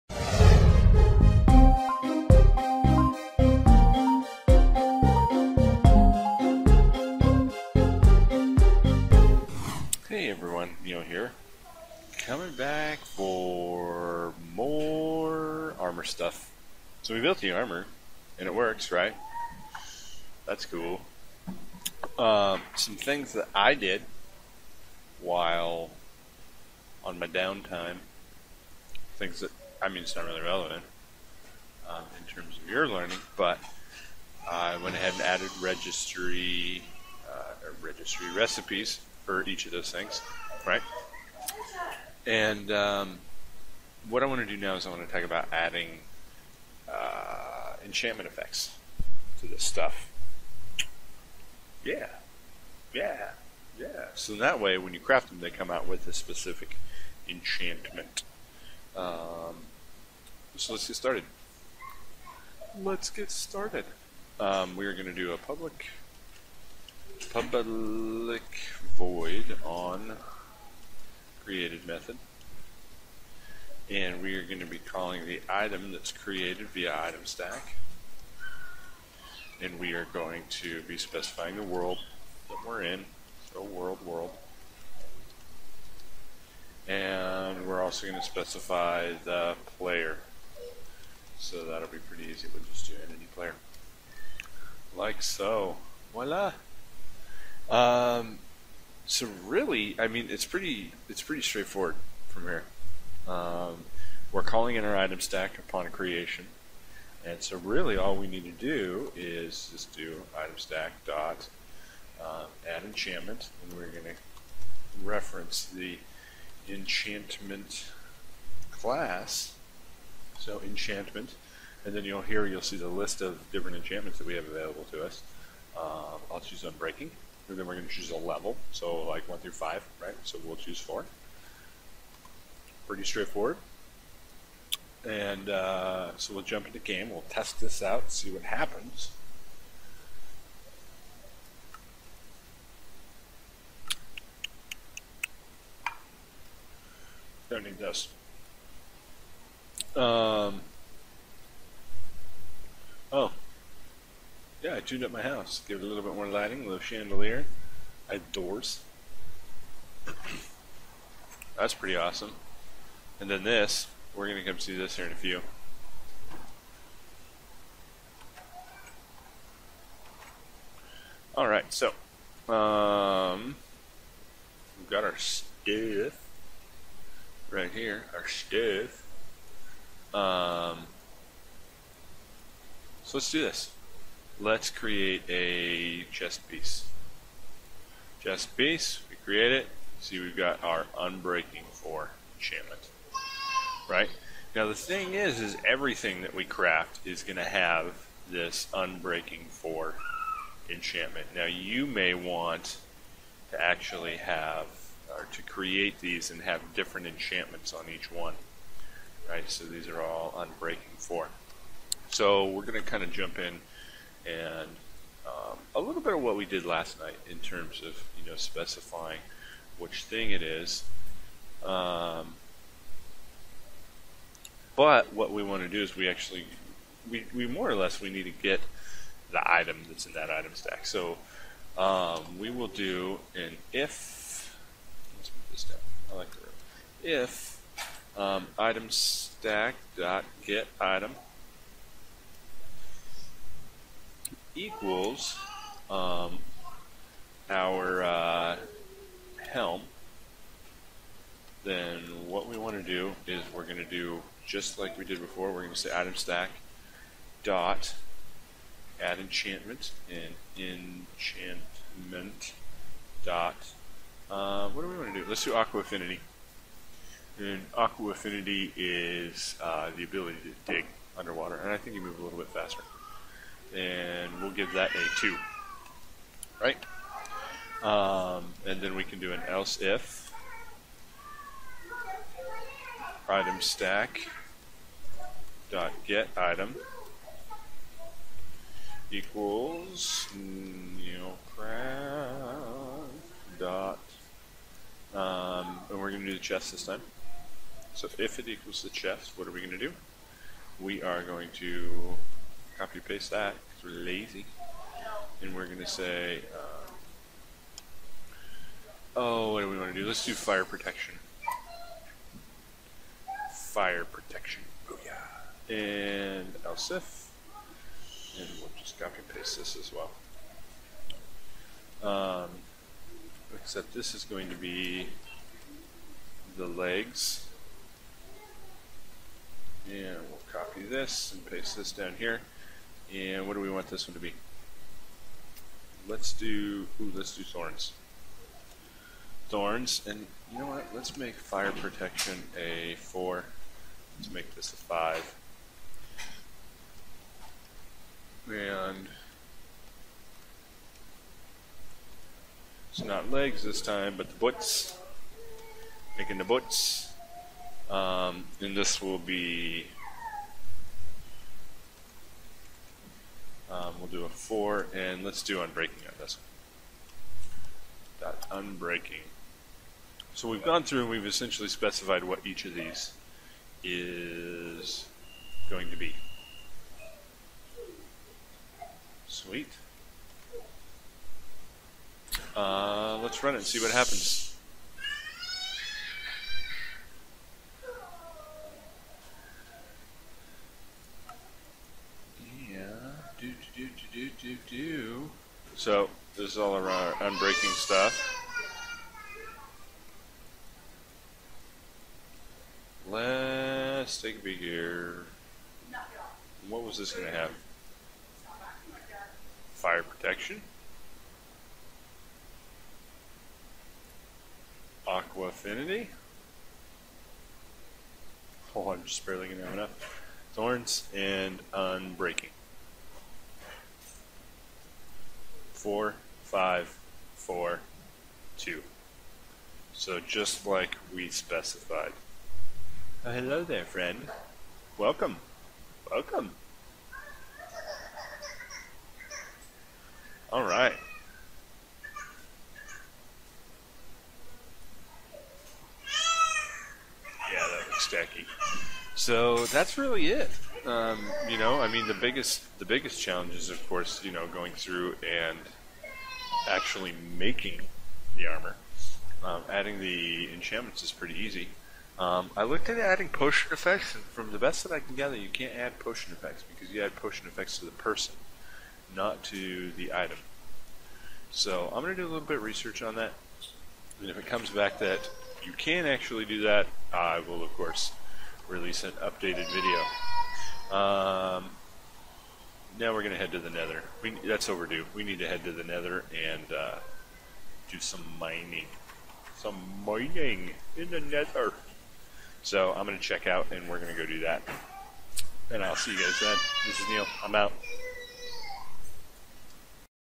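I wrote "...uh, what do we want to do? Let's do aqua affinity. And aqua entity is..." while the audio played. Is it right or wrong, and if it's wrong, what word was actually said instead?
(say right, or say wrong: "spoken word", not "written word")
wrong: "affinity", not "entity".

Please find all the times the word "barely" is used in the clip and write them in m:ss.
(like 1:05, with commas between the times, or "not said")
6:59.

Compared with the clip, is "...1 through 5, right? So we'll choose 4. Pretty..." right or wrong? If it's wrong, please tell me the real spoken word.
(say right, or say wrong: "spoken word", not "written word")
right.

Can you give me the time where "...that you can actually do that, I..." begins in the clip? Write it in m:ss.
7:54.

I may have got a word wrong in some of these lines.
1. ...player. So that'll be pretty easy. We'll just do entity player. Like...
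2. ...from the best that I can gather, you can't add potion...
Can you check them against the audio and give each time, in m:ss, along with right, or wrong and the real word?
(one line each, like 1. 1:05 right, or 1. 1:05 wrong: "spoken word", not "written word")
1. 1:29 right
2. 7:44 right.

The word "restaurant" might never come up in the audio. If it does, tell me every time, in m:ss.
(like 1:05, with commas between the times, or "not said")
not said.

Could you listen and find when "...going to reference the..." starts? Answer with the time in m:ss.
1:53.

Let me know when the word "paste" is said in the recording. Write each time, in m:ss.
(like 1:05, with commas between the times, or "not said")
5:02, 5:19, 5:31.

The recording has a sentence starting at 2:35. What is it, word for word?
Give it a little bit more lighting, a little chandelier.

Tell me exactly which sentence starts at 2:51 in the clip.
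Alright, so, um, we've got our stuff right here, our stuff.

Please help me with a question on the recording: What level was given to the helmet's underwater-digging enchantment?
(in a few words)
2.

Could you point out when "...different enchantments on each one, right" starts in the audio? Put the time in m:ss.
3:26.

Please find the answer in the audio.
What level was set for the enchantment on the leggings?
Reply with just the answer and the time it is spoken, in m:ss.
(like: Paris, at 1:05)
5, at 5:44.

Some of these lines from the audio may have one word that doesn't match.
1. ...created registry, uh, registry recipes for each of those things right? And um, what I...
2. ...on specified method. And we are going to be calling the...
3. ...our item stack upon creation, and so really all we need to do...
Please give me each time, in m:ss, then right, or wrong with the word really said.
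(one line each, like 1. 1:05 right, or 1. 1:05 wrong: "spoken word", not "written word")
1. 0:35 wrong: "added", not "created"
2. 1:09 wrong: "created", not "specified"
3. 1:44 right.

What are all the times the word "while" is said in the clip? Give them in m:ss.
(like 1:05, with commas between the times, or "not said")
0:25.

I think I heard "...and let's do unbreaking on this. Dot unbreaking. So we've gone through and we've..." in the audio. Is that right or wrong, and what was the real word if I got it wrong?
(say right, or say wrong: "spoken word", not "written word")
right.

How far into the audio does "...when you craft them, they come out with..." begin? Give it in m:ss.
0:54.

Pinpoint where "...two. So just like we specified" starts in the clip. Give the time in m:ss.
7:08.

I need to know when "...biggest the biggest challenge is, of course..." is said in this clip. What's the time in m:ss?
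7:32.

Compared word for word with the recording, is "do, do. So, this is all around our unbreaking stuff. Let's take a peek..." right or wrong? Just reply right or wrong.
right.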